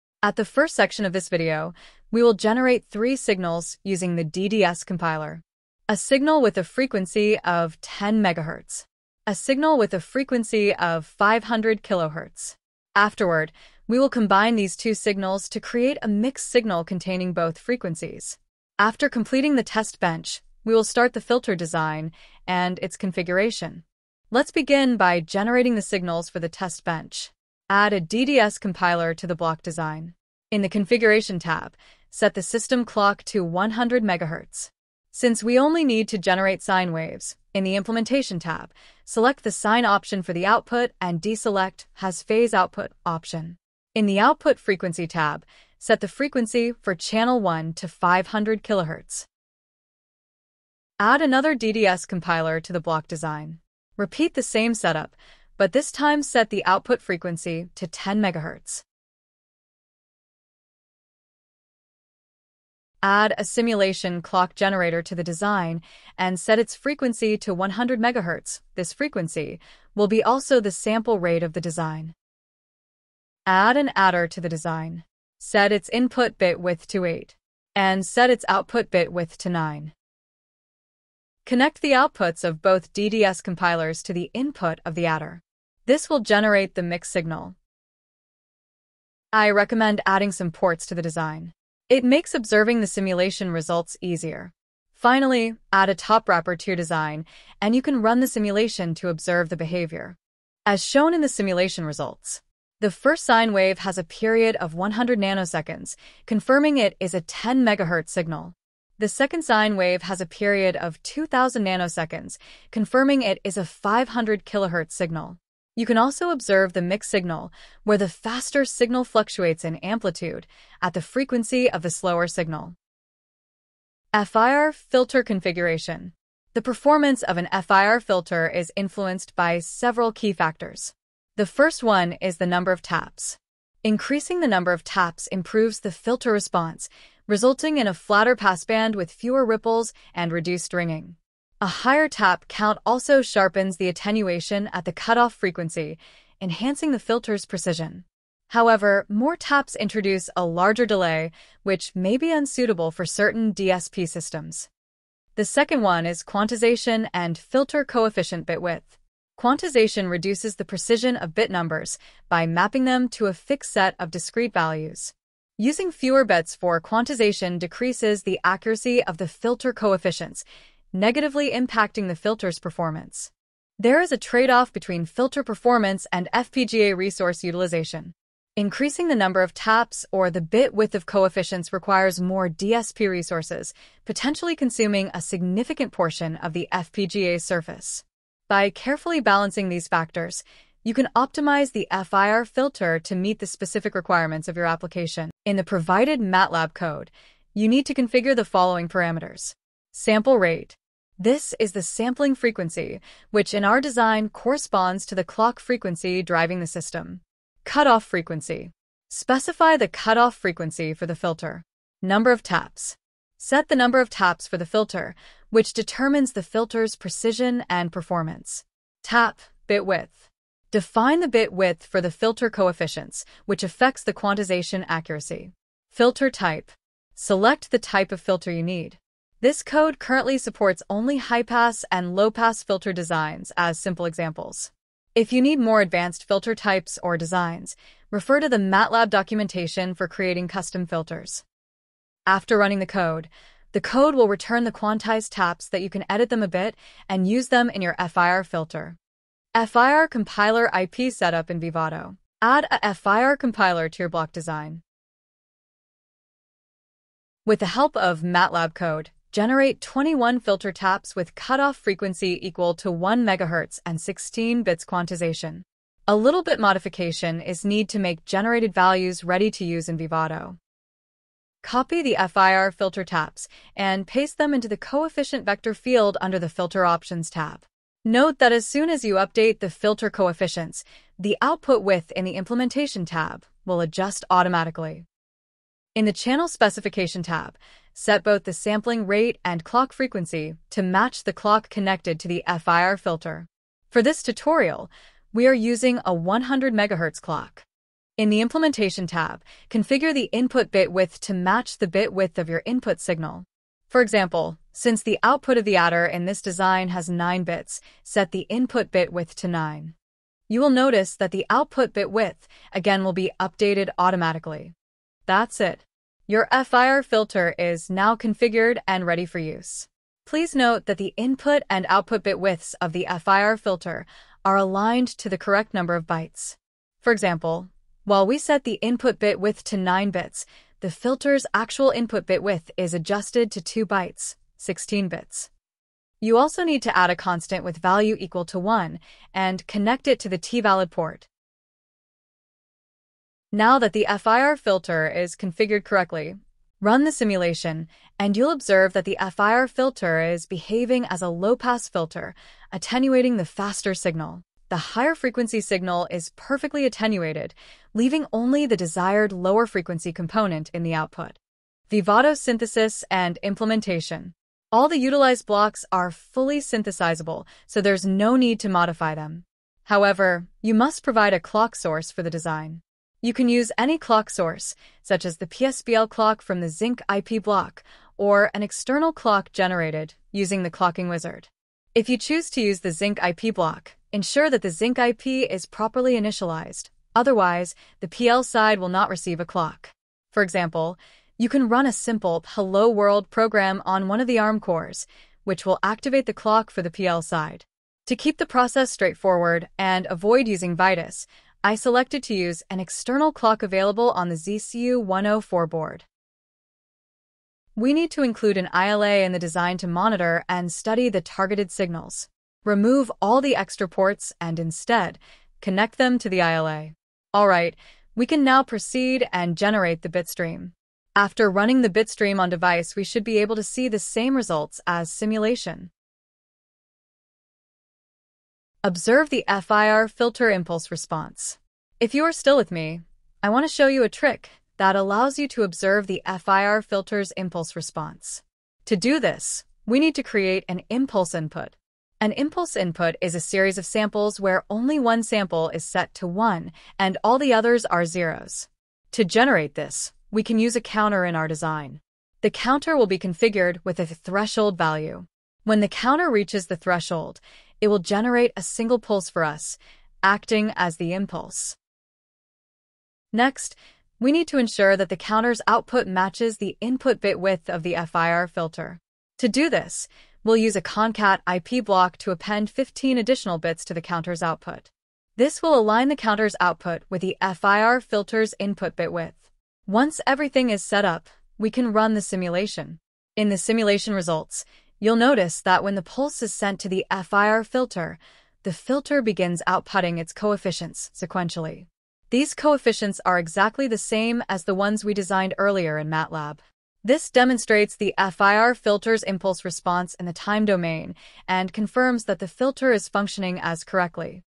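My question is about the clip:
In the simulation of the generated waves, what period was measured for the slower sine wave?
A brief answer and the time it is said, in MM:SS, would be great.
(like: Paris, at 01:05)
2000 nanoseconds, at 01:51.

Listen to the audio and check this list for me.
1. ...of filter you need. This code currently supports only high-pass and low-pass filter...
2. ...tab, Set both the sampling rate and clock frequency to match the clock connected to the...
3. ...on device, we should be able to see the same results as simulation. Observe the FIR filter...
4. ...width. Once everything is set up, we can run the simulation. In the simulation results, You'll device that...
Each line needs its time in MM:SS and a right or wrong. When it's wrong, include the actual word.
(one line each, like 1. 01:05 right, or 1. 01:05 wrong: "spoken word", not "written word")
1. 03:48 right
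2. 04:47 right
3. 07:02 right
4. 07:59 wrong: "notice", not "device".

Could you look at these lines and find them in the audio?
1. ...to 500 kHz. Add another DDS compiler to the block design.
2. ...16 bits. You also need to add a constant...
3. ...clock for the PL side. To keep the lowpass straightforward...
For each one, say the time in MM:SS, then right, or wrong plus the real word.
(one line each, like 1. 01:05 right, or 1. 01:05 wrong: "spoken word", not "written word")
1. 00:47 right
2. 05:34 right
3. 06:36 wrong: "process", not "lowpass".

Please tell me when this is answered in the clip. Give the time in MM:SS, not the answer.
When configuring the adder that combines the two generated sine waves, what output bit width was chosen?
01:18.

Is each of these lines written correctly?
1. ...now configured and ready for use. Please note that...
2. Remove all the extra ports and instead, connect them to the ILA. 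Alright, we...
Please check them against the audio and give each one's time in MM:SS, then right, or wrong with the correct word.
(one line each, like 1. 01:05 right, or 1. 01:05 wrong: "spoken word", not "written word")
1. 05:17 right
2. 06:52 right.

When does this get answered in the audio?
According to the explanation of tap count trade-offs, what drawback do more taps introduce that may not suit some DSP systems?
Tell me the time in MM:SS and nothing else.
02:30.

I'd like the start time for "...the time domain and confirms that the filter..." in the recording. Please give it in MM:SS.
08:20.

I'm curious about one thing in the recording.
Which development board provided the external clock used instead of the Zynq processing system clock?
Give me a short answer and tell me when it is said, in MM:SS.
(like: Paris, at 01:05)
ZCU-104, at 06:44.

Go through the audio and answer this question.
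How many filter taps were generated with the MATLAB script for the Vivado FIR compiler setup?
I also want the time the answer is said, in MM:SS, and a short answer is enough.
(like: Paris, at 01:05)
21, at 04:19.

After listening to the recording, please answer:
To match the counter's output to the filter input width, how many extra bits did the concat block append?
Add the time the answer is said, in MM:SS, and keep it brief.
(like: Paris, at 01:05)
15, at 07:52.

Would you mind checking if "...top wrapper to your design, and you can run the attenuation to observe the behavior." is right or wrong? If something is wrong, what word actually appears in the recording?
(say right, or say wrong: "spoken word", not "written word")
wrong: "simulation", not "attenuation".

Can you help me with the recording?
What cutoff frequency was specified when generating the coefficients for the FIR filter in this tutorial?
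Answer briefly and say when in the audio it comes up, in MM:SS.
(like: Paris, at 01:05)
1 MHz, at 04:22.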